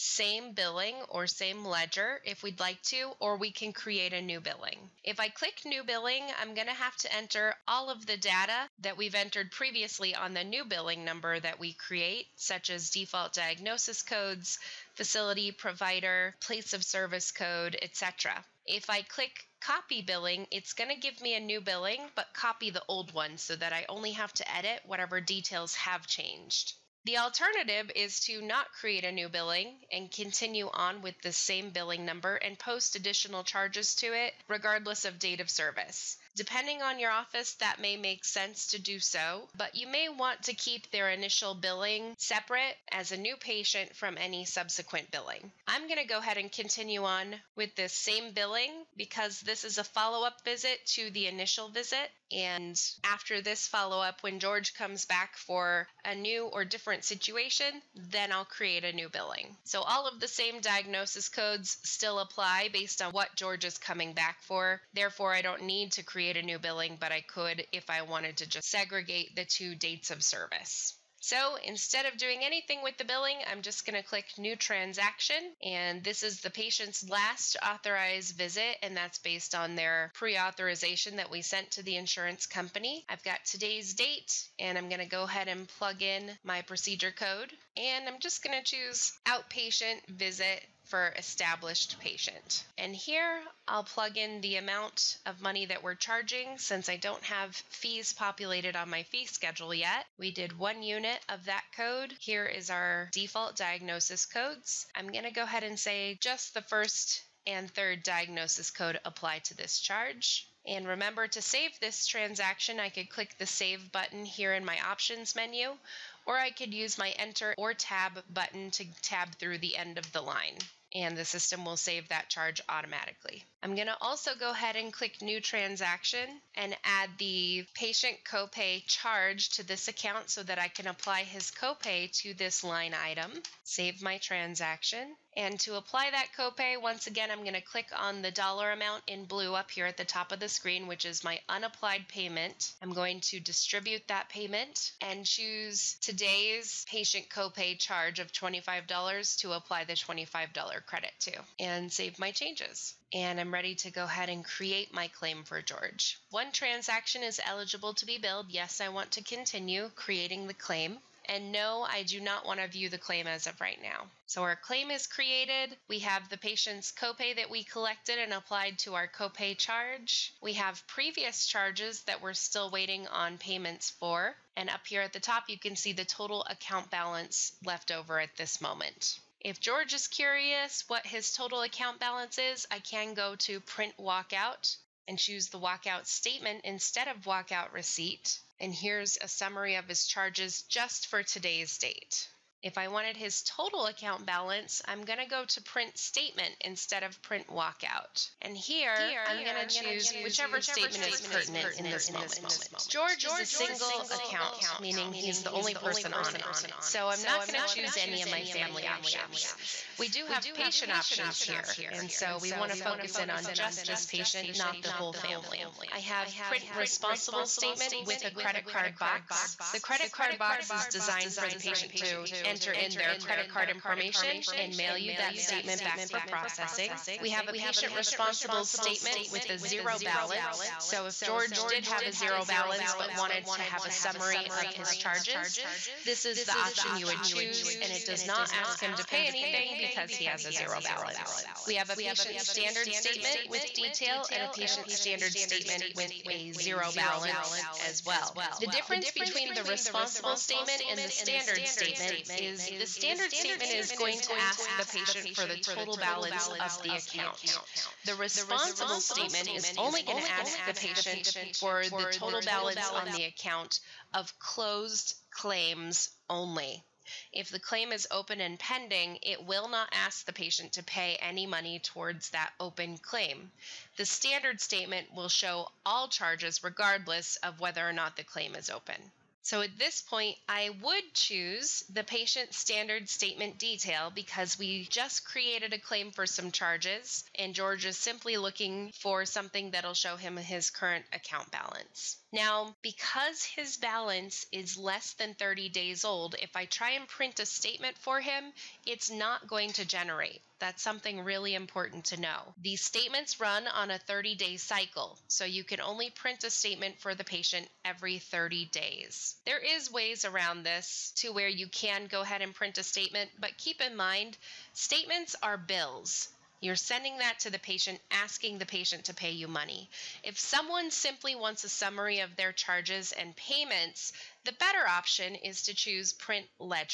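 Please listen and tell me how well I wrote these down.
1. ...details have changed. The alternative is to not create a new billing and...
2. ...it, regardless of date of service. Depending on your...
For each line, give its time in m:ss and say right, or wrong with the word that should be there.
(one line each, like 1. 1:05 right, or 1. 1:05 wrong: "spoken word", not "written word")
1. 0:25 right
2. 0:34 right.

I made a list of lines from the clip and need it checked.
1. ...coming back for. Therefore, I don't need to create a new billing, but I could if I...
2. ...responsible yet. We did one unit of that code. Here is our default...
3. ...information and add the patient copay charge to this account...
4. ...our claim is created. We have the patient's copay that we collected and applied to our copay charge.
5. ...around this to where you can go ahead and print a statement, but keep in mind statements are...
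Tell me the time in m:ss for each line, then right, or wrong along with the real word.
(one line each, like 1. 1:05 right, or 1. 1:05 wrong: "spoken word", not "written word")
1. 1:03 right
2. 1:39 wrong: "schedule", not "responsible"
3. 2:05 wrong: "transaction", not "information"
4. 2:44 right
5. 5:10 right.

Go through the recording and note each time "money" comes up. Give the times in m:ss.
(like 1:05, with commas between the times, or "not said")
1:35, 4:31, 5:19.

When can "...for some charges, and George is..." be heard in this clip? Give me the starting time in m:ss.
4:46.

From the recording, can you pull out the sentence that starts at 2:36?
One transaction is eligible to be billed.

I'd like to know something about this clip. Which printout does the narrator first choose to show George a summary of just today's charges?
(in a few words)
walkout statement.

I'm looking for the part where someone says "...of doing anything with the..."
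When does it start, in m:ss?
1:12.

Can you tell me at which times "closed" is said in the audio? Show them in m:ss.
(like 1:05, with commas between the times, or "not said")
4:24.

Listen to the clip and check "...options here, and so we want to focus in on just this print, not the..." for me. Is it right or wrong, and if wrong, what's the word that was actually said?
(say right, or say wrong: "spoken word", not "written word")
wrong: "patient", not "print".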